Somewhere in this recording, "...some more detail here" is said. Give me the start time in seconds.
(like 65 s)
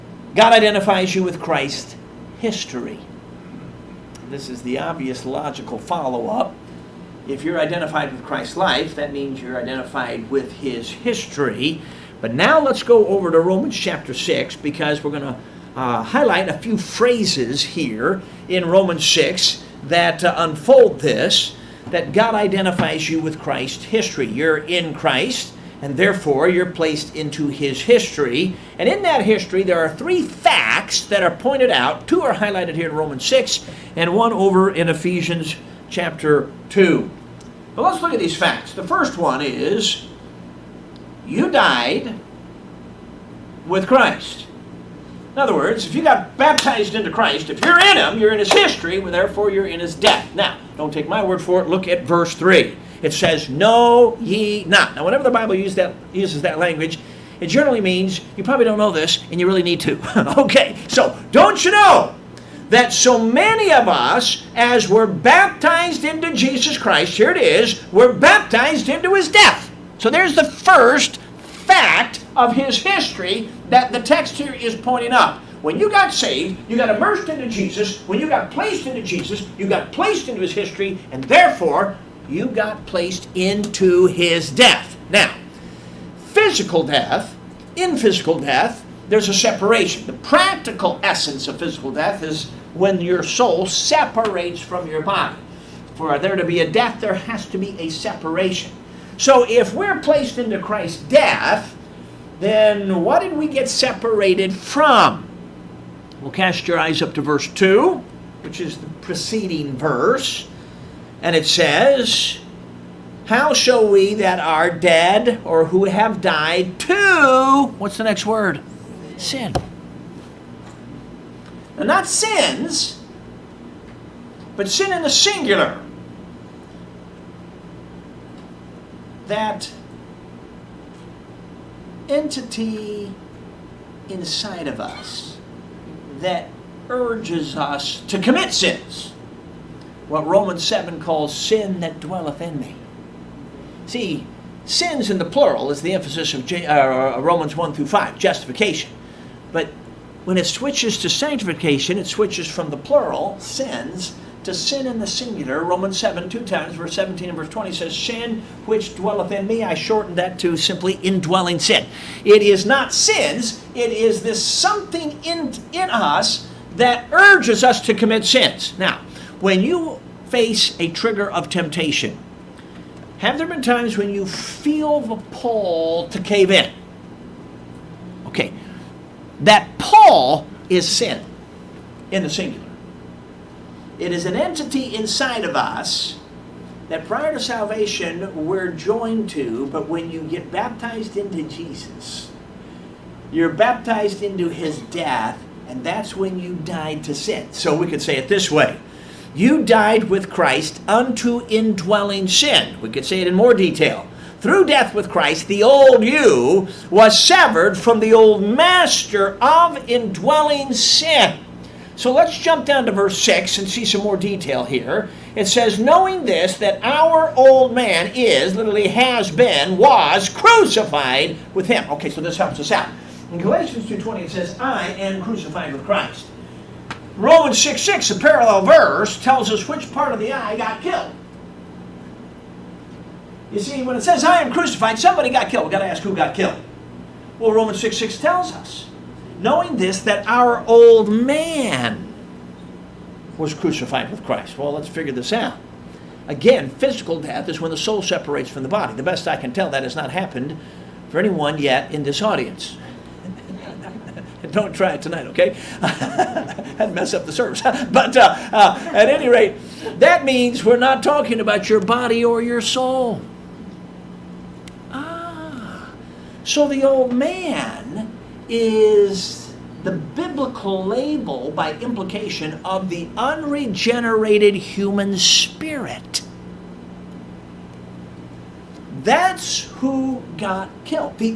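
213 s.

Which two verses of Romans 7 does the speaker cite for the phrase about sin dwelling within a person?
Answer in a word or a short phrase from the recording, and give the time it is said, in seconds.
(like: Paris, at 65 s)
17 and 20, at 156 s.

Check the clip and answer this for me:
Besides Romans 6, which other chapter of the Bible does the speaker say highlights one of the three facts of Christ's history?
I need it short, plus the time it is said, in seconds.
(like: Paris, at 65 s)
Ephesians chapter 2, at 34 s.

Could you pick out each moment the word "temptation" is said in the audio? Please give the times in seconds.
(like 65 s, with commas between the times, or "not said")
171 s.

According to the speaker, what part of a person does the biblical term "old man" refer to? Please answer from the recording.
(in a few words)
The unregenerated human spirit.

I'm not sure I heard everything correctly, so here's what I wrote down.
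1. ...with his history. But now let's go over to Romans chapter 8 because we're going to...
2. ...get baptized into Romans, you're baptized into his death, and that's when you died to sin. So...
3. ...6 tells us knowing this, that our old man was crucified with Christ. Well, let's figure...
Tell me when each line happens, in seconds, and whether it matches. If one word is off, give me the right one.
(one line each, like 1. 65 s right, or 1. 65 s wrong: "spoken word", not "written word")
1. 10 s wrong: "6", not "8"
2. 190 s wrong: "Jesus", not "Romans"
3. 237 s right.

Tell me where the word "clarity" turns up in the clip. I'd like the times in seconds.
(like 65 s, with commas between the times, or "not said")
not said.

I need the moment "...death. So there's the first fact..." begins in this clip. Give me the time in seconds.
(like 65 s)
69 s.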